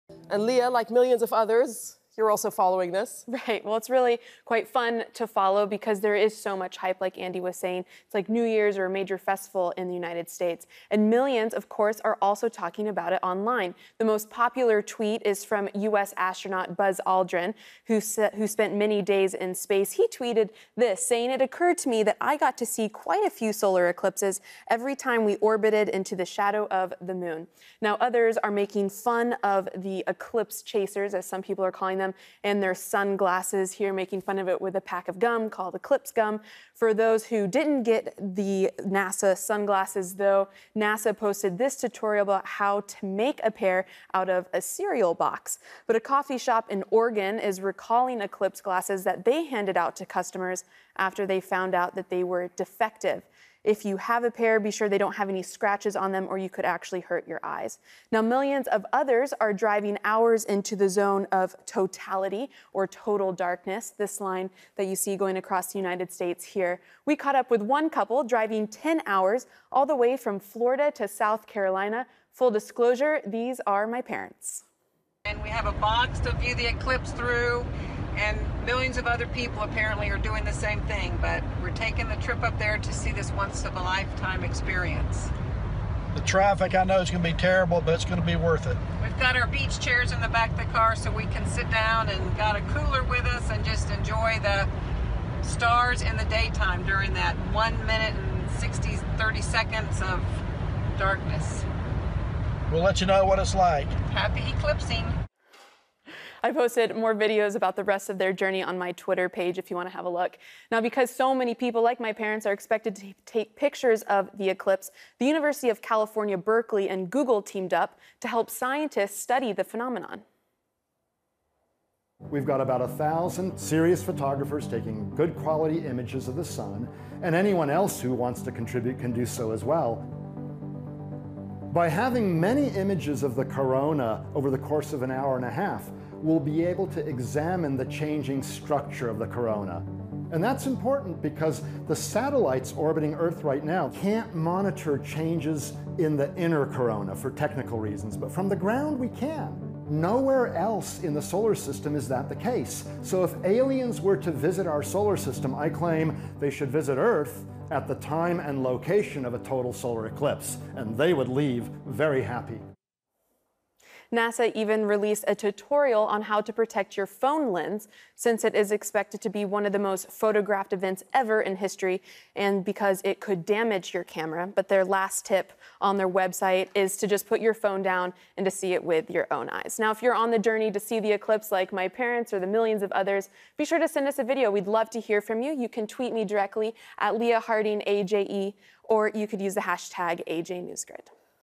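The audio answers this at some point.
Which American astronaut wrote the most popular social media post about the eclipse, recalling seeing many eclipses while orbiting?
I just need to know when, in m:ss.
0:16.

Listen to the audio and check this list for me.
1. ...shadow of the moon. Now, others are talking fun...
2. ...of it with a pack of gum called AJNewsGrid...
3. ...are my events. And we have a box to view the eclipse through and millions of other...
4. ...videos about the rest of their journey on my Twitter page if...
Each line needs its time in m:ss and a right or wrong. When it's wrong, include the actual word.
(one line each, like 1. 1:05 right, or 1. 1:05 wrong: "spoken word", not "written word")
1. 0:26 wrong: "making", not "talking"
2. 0:34 wrong: "Eclipse", not "AJNewsGrid"
3. 1:13 wrong: "parents", not "events"
4. 1:47 right.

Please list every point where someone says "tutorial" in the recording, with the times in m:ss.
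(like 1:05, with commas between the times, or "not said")
0:41, 2:45.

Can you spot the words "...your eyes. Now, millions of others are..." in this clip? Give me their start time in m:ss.
0:57.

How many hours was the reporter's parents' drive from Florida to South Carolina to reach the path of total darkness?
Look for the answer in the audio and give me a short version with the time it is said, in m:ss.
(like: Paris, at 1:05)
10 hours, at 1:08.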